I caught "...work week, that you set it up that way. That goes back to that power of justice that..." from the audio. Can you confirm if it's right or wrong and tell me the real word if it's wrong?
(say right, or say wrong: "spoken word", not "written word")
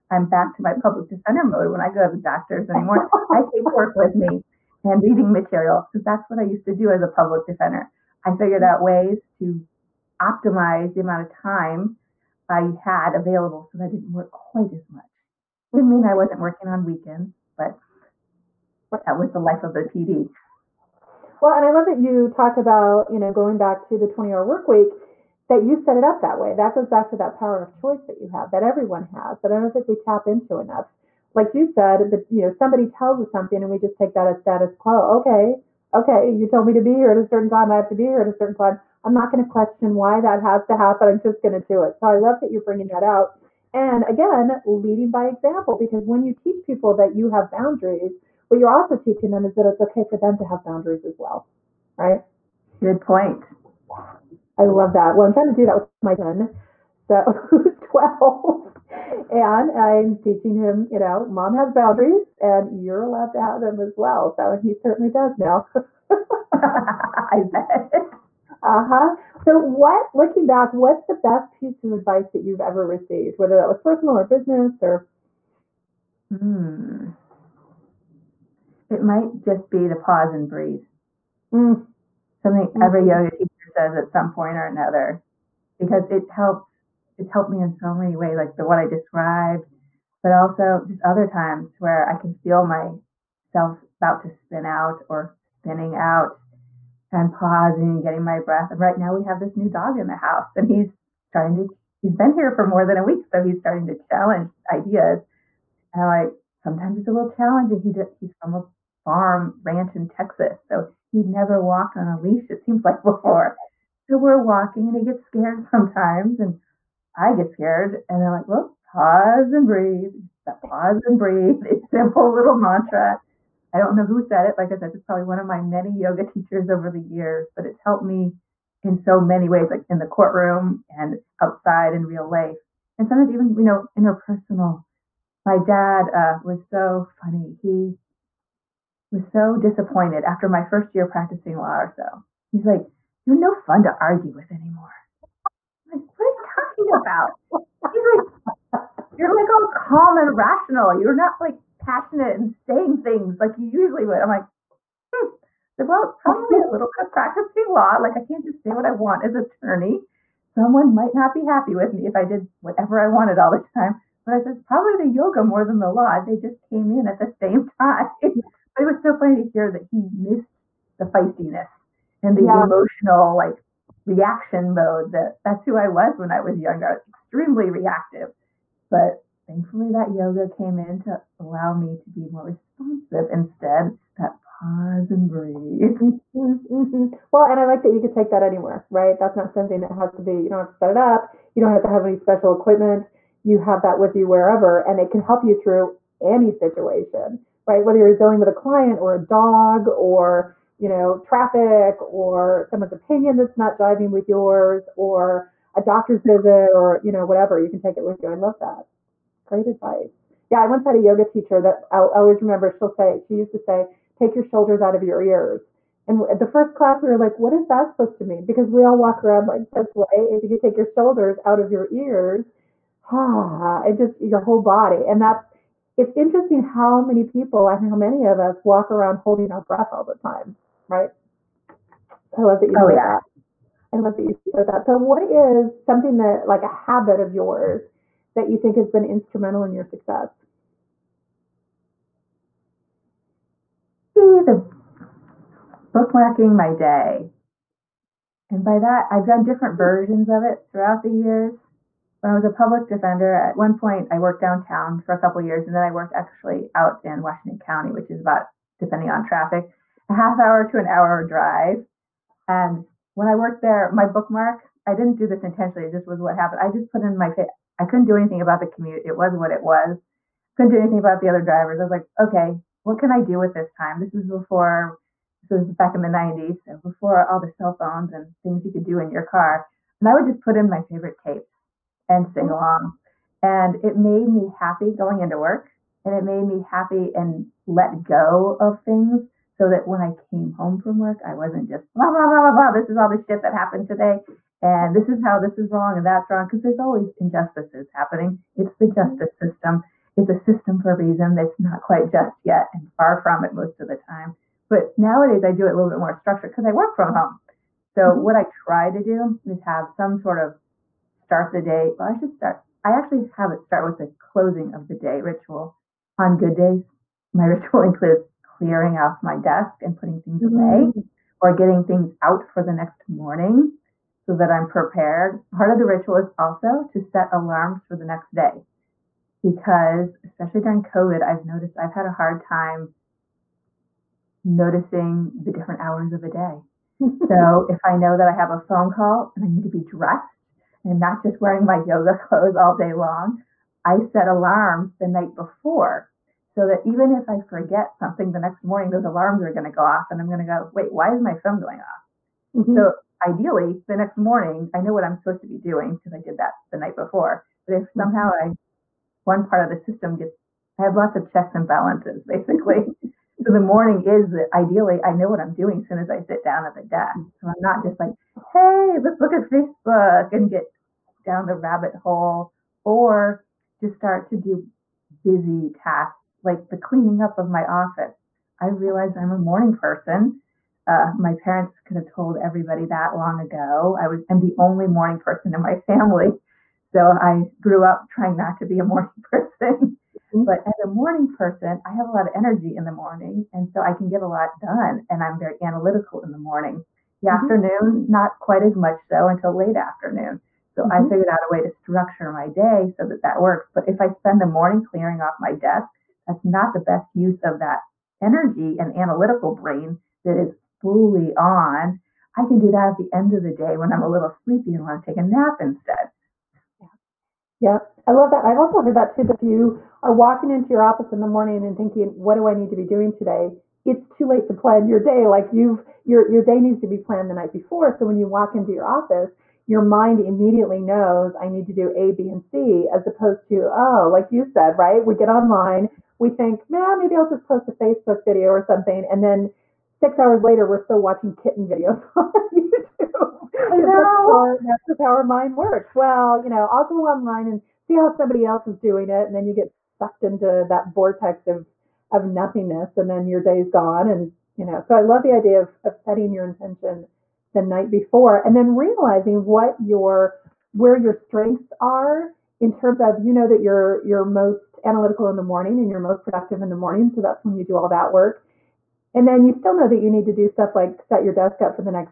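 wrong: "choice", not "justice".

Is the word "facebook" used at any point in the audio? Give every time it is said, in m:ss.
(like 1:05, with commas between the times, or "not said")
6:09, 7:17.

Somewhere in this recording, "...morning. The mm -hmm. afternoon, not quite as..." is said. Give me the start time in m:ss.
6:36.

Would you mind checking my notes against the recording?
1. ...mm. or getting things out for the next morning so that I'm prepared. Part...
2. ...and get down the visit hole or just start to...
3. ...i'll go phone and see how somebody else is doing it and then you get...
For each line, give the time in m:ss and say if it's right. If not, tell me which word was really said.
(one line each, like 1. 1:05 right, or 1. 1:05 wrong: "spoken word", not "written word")
1. 5:20 right
2. 6:10 wrong: "rabbit", not "visit"
3. 7:26 wrong: "online", not "phone".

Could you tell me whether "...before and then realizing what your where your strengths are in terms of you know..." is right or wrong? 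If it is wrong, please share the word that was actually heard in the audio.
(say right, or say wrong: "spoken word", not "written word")
right.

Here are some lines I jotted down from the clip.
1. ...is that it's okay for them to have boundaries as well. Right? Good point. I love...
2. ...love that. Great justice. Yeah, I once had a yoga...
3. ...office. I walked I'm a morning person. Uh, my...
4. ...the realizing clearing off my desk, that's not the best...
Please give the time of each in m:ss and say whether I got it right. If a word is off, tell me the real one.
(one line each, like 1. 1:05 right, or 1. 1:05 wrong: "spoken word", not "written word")
1. 0:49 right
2. 3:28 wrong: "advice", not "justice"
3. 6:17 wrong: "realized", not "walked"
4. 6:44 wrong: "morning", not "realizing".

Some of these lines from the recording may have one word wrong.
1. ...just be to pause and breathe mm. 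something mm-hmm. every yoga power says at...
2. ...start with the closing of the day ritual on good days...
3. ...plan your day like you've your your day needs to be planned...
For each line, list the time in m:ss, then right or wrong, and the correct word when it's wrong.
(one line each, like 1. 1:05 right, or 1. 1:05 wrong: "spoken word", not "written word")
1. 1:19 wrong: "teacher", not "power"
2. 5:13 right
3. 7:04 right.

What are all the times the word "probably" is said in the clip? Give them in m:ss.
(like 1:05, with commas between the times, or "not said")
2:05, 2:36, 2:44.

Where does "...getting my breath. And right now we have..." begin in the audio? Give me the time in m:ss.
1:38.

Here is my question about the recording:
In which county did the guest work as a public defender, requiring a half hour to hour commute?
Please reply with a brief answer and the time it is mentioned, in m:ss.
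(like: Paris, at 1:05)
Washington County, at 4:17.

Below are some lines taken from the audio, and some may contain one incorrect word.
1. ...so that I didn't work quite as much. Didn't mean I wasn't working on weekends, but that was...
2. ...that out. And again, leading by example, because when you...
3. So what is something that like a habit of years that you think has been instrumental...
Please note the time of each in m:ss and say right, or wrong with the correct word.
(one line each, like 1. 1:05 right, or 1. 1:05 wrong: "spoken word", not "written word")
1. 0:13 right
2. 0:42 right
3. 3:54 wrong: "yours", not "years".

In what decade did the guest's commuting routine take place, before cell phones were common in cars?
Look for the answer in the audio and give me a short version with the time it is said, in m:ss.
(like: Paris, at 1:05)
The 90s, at 4:36.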